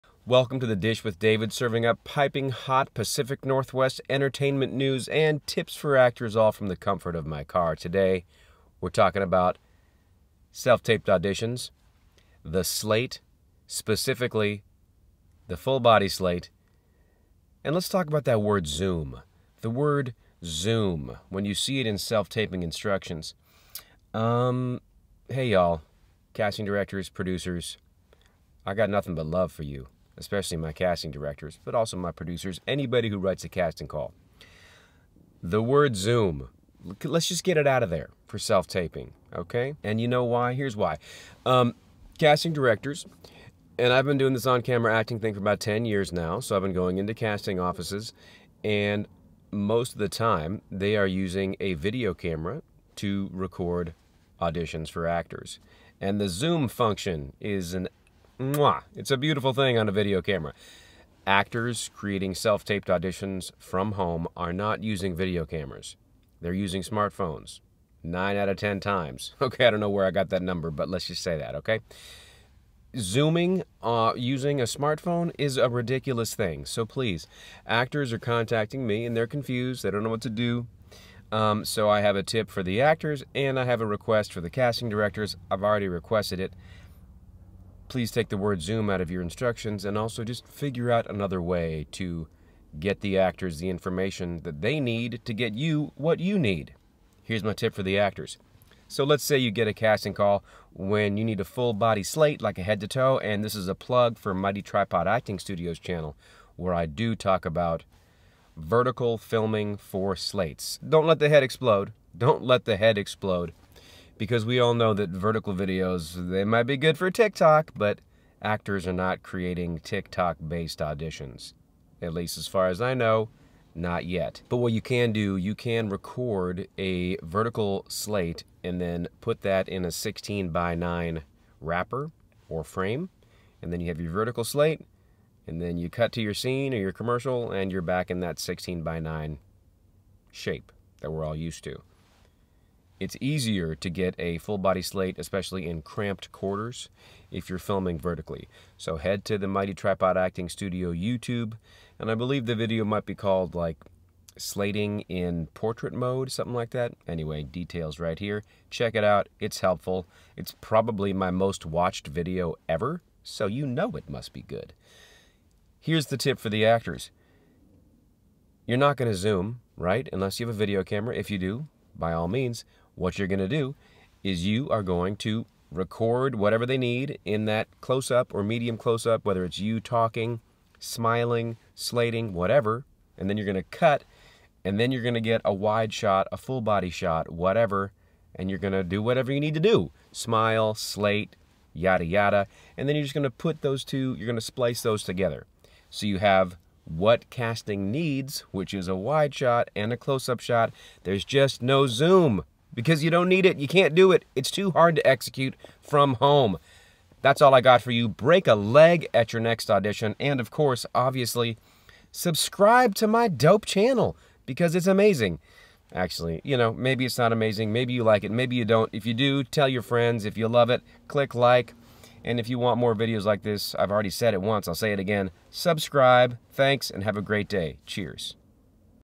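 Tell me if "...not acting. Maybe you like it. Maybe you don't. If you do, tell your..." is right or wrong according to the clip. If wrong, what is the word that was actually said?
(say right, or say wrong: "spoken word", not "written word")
wrong: "amazing", not "acting".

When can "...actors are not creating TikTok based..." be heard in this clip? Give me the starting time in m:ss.
1:58.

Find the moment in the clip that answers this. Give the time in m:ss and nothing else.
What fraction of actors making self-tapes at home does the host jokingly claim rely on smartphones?
1:08.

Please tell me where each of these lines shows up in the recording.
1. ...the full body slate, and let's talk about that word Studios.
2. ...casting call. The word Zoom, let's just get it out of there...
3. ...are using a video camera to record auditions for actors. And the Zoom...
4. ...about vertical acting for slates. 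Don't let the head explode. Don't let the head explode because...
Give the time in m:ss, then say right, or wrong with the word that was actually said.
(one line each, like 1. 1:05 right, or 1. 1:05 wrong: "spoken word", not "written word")
1. 0:15 wrong: "Zoom", not "Studios"
2. 0:33 right
3. 0:50 right
4. 1:47 wrong: "filming", not "acting".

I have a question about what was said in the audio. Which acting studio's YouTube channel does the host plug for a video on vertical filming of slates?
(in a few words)
Mighty Tripod Acting Studios.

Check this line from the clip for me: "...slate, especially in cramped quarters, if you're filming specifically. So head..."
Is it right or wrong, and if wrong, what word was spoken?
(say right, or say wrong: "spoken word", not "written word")
wrong: "vertically", not "specifically".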